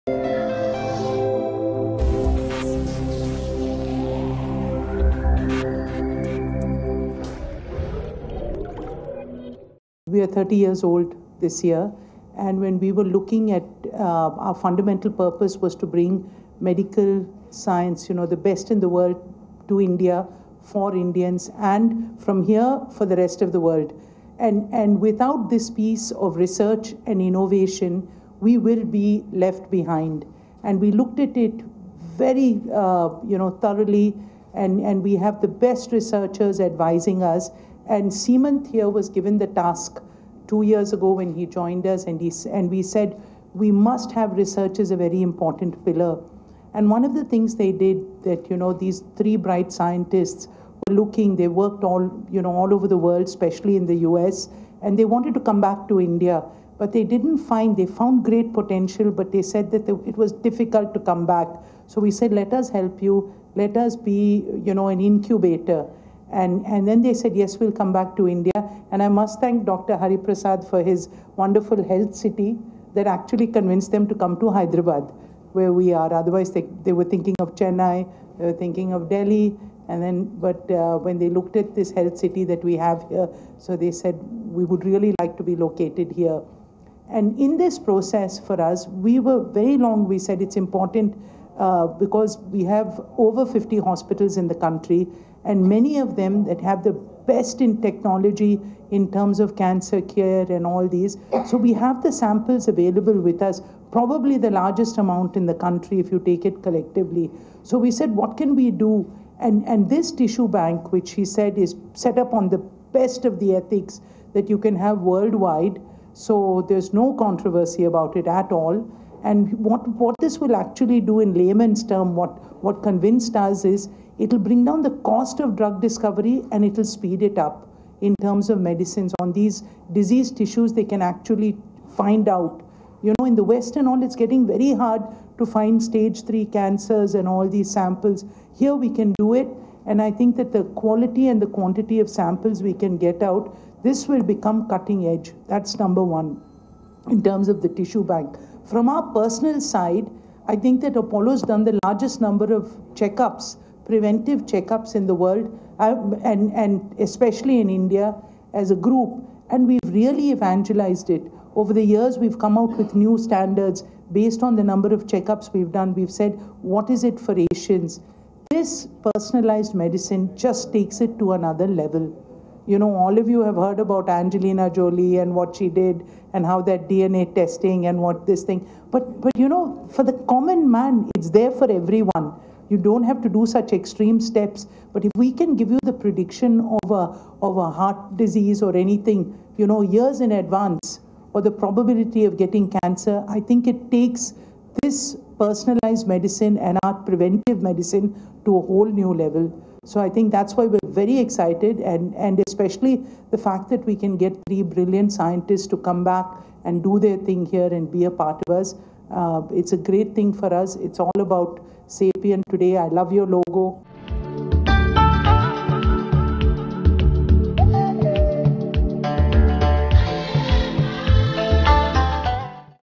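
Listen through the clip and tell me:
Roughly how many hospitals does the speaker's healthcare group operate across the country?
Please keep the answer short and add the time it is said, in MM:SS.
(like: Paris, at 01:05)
over 50, at 01:33.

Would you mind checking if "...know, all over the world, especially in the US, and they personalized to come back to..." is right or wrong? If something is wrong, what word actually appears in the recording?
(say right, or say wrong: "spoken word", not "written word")
wrong: "wanted", not "personalized".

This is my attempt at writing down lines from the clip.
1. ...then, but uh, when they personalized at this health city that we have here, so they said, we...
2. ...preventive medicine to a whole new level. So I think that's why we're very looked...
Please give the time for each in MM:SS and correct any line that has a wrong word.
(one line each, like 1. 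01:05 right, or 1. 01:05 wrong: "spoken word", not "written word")
1. 01:20 wrong: "looked", not "personalized"
2. 03:16 wrong: "excited", not "looked".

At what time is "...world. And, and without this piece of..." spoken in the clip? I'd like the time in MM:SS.
00:23.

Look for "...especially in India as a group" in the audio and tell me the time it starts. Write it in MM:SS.
02:36.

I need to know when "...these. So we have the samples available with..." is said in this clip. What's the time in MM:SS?
01:40.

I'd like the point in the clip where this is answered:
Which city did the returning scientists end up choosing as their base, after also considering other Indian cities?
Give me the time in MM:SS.
01:14.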